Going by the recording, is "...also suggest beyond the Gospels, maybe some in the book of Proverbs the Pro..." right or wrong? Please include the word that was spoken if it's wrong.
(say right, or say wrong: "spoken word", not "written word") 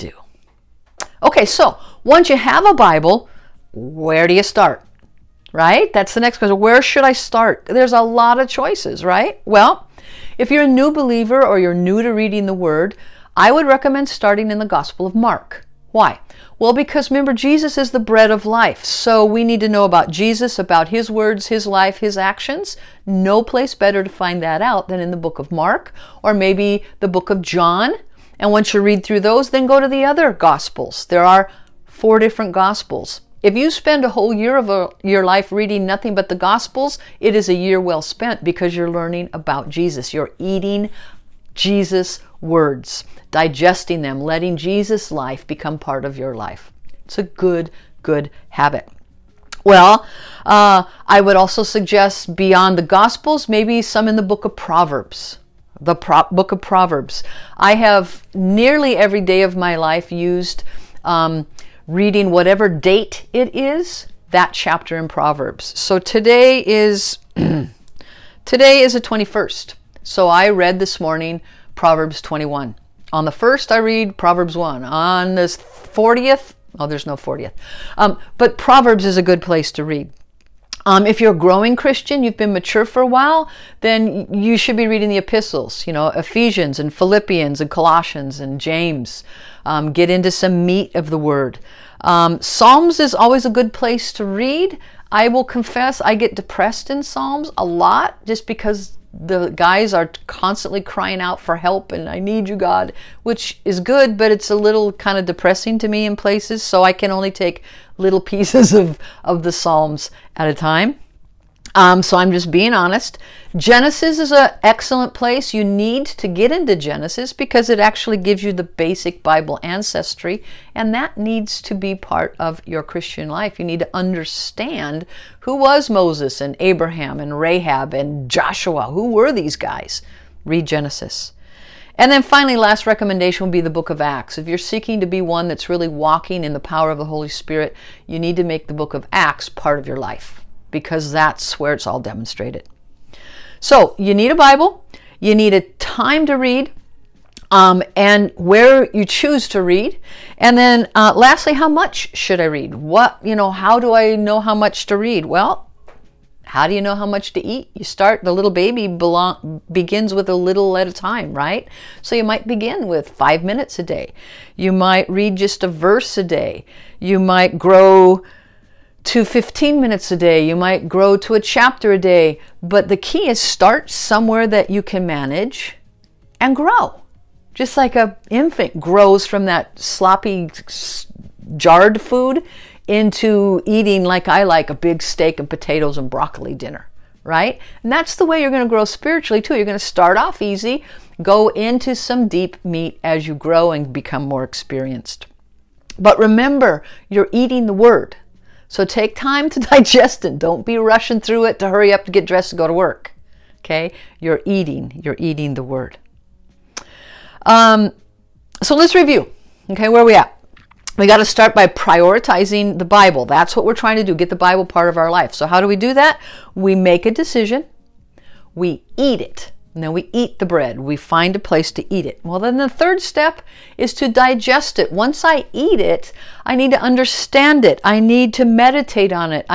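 right.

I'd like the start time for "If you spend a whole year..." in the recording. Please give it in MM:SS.
00:33.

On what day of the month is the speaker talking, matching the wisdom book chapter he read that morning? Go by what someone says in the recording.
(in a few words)
21st.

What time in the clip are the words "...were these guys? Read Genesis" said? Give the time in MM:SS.
02:09.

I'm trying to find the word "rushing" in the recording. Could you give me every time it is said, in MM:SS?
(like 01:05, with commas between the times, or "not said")
03:20.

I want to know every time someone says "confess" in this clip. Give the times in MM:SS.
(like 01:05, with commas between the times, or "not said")
01:35.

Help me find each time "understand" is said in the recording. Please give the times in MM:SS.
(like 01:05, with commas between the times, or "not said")
02:03, 03:46.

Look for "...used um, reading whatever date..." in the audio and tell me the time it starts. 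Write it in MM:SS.
01:00.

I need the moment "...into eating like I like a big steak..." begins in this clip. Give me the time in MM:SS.
03:02.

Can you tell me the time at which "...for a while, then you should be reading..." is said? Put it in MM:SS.
01:22.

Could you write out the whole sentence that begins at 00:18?
So we need to know about Jesus, about his words, his life, his actions.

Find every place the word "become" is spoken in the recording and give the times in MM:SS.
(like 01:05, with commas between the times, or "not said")
00:45, 03:13.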